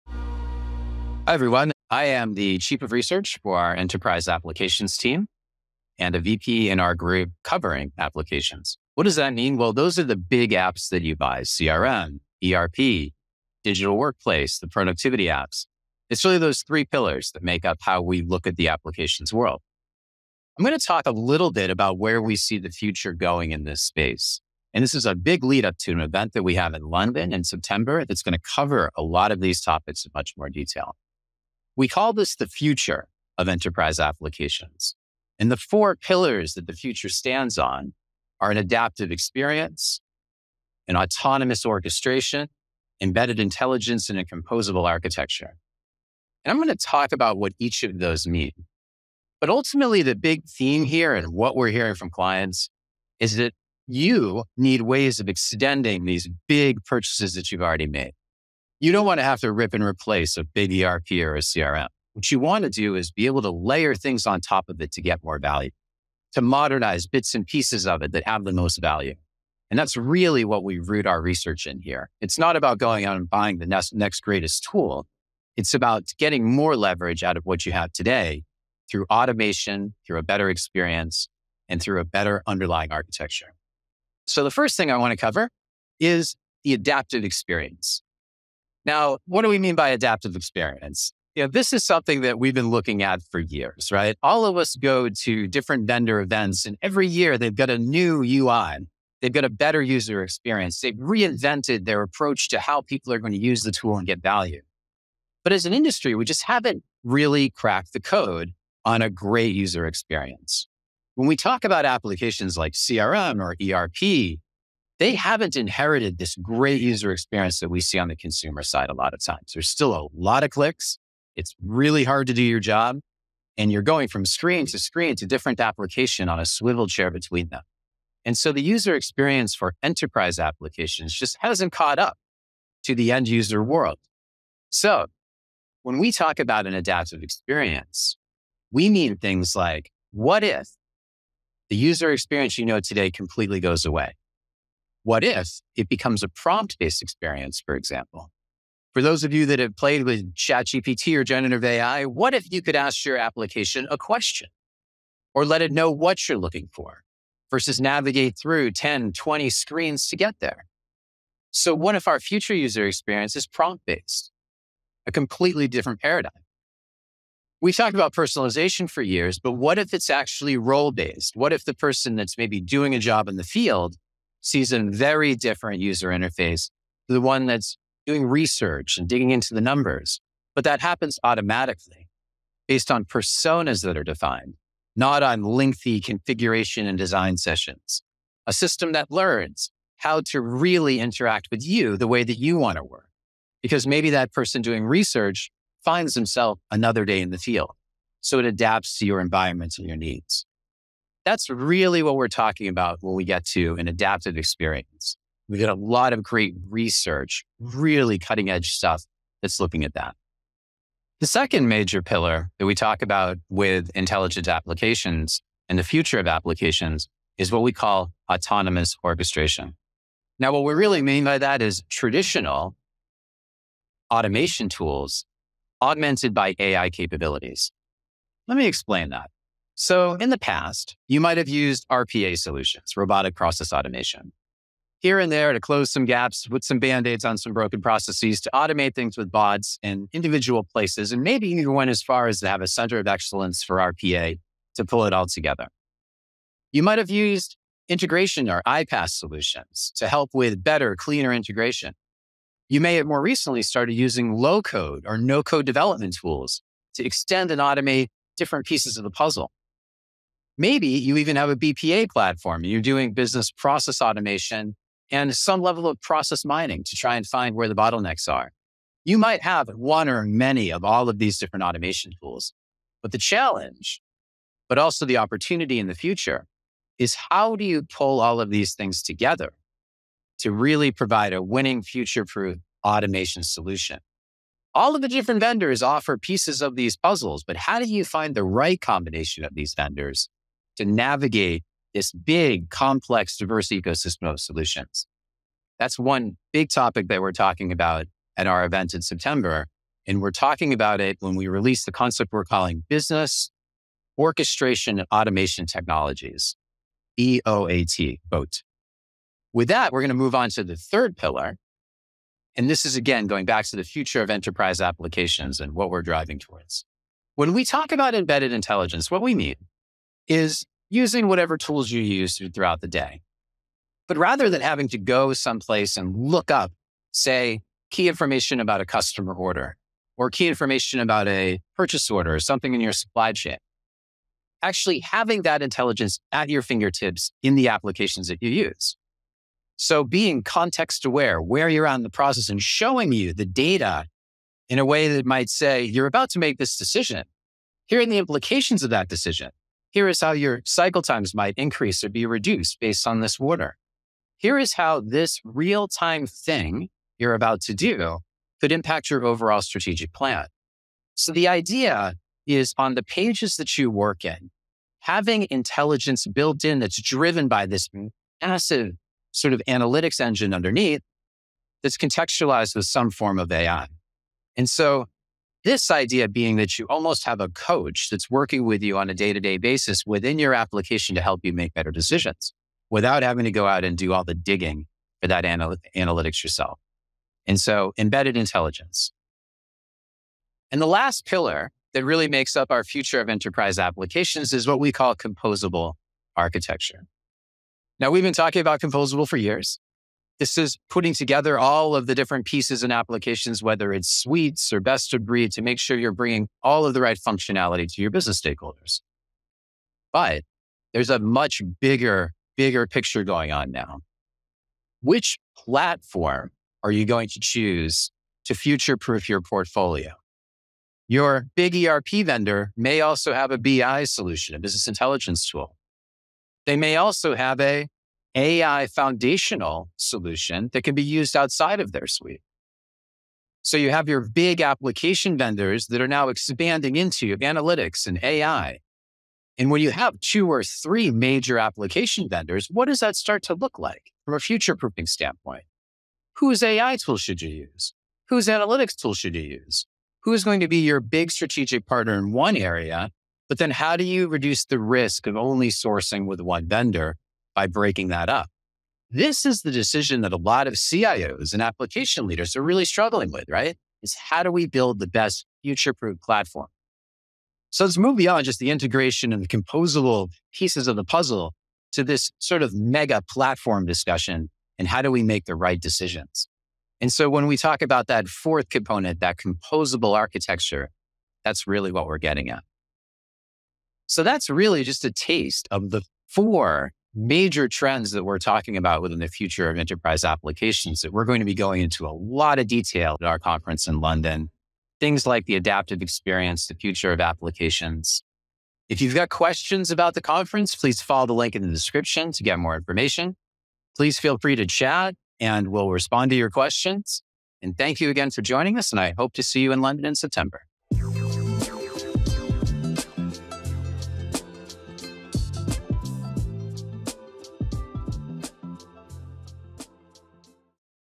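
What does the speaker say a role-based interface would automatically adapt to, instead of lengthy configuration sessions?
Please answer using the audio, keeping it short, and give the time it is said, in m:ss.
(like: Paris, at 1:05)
personas, at 3:03.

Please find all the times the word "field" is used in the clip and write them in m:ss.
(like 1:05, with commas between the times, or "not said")
2:53, 3:17.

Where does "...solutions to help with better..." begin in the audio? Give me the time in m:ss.
4:09.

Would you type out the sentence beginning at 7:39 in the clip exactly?
This is the decision that a lot of CIOs and application leaders are really struggling with, right?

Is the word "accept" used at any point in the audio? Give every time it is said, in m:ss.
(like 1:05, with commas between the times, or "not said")
not said.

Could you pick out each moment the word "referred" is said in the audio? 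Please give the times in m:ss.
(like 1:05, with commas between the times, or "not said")
not said.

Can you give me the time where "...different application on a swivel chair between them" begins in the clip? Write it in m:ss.
2:05.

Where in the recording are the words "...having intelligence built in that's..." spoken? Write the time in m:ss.
6:05.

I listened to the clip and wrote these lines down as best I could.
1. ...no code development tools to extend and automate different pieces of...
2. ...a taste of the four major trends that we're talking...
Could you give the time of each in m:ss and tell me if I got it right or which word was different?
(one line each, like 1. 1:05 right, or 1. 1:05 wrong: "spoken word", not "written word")
1. 4:15 right
2. 8:05 right.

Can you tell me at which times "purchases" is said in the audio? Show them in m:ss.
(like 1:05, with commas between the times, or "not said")
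0:56, 5:31.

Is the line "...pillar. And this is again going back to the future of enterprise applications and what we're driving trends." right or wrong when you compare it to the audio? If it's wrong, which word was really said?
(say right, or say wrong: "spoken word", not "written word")
wrong: "towards", not "trends".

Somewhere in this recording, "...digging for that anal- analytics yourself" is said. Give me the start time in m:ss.
6:24.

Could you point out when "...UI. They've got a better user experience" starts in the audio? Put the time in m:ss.
1:38.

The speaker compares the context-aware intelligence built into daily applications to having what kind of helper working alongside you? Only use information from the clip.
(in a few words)
a coach.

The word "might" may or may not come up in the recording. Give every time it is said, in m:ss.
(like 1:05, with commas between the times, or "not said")
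3:51, 4:06, 4:29, 5:45, 5:51.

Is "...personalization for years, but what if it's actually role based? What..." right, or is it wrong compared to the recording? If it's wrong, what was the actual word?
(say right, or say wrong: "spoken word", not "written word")
right.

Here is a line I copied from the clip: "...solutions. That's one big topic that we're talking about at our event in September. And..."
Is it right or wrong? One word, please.
right.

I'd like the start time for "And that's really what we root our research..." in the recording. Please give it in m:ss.
1:09.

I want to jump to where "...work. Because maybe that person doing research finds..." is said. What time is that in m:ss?
3:12.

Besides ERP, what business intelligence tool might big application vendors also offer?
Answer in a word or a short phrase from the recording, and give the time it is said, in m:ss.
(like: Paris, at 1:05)
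BI solution, at 7:03.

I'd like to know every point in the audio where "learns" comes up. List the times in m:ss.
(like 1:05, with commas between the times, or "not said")
3:09.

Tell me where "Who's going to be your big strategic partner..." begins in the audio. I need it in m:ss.
7:30.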